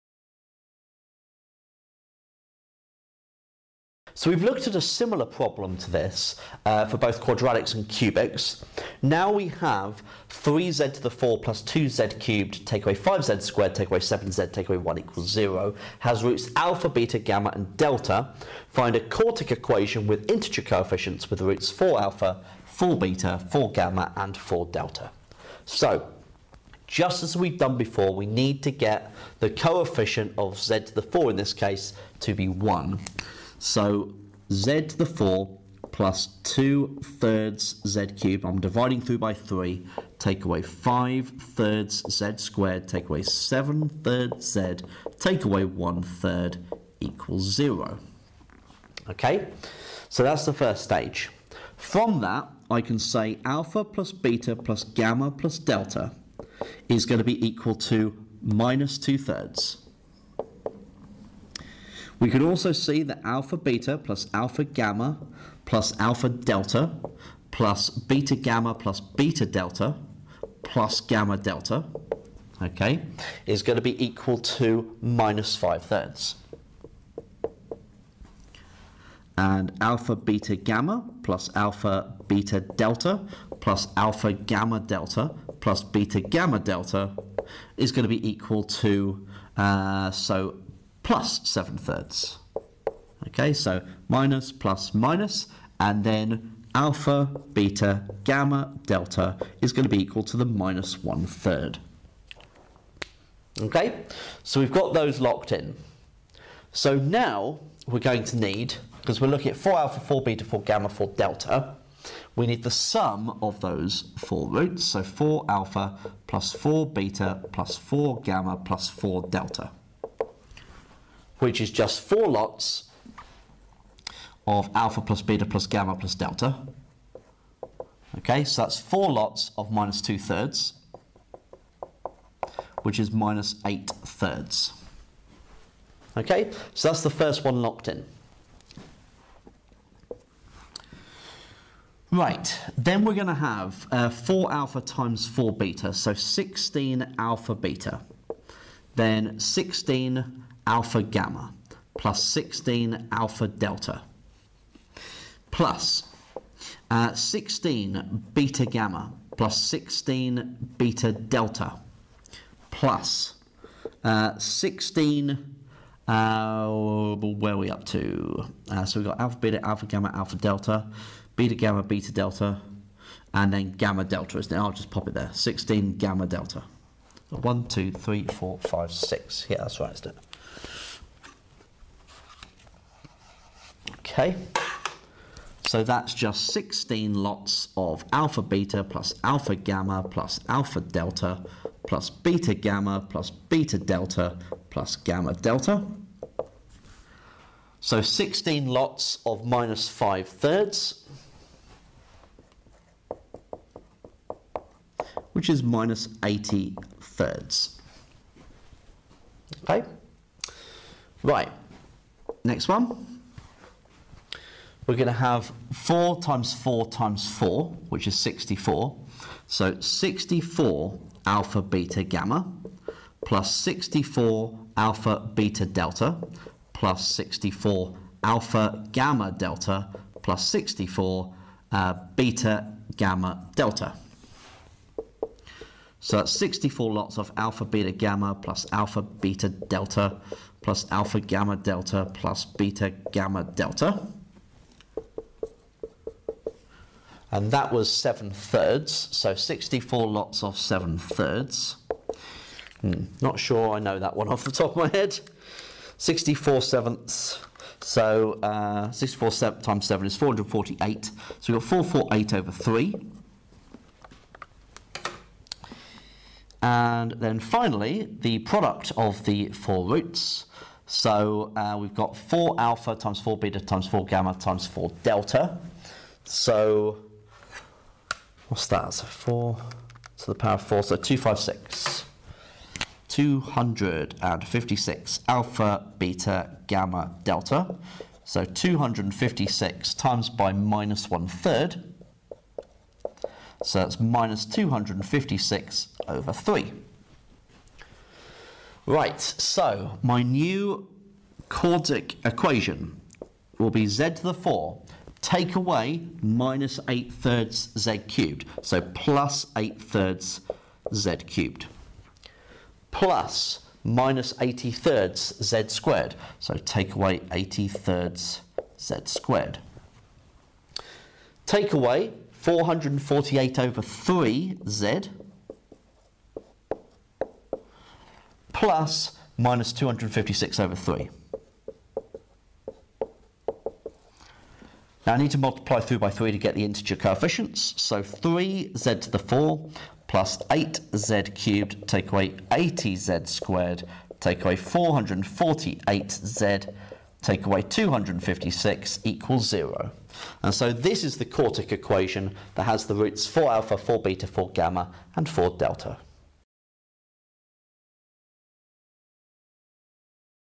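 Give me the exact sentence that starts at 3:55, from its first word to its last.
So that's 64 lots of alpha beta gamma plus alpha beta delta plus alpha gamma delta plus beta gamma delta.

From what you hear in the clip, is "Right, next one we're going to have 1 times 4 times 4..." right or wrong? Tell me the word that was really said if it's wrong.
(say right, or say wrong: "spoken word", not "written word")
wrong: "4", not "1".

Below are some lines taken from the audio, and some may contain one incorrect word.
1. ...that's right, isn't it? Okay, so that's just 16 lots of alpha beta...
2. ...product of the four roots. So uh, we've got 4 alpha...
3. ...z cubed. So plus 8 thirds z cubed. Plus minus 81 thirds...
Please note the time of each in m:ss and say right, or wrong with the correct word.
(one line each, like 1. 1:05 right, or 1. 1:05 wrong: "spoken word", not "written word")
1. 2:59 right
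2. 4:28 right
3. 5:07 wrong: "80", not "81".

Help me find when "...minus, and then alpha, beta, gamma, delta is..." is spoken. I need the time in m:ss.
1:34.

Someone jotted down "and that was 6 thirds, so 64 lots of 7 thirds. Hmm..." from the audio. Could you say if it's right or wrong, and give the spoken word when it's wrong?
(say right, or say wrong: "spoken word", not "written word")
wrong: "7", not "6".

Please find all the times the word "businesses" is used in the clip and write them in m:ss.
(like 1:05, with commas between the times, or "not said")
not said.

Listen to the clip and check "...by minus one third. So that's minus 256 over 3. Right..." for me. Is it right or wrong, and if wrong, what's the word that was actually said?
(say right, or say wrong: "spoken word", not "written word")
right.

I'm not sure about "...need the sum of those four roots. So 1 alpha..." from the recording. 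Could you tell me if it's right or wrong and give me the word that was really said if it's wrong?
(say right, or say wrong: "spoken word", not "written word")
wrong: "4", not "1".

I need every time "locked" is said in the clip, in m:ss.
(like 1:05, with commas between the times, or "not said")
1:45, 2:17.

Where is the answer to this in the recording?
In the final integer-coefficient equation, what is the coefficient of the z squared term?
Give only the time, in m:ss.
5:41.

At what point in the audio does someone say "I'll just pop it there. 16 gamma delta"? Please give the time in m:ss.
2:54.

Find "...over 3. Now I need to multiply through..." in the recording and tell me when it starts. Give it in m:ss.
5:30.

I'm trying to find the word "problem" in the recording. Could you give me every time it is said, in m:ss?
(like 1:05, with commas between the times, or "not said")
0:05.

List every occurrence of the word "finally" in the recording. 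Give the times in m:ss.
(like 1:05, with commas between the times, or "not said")
4:27.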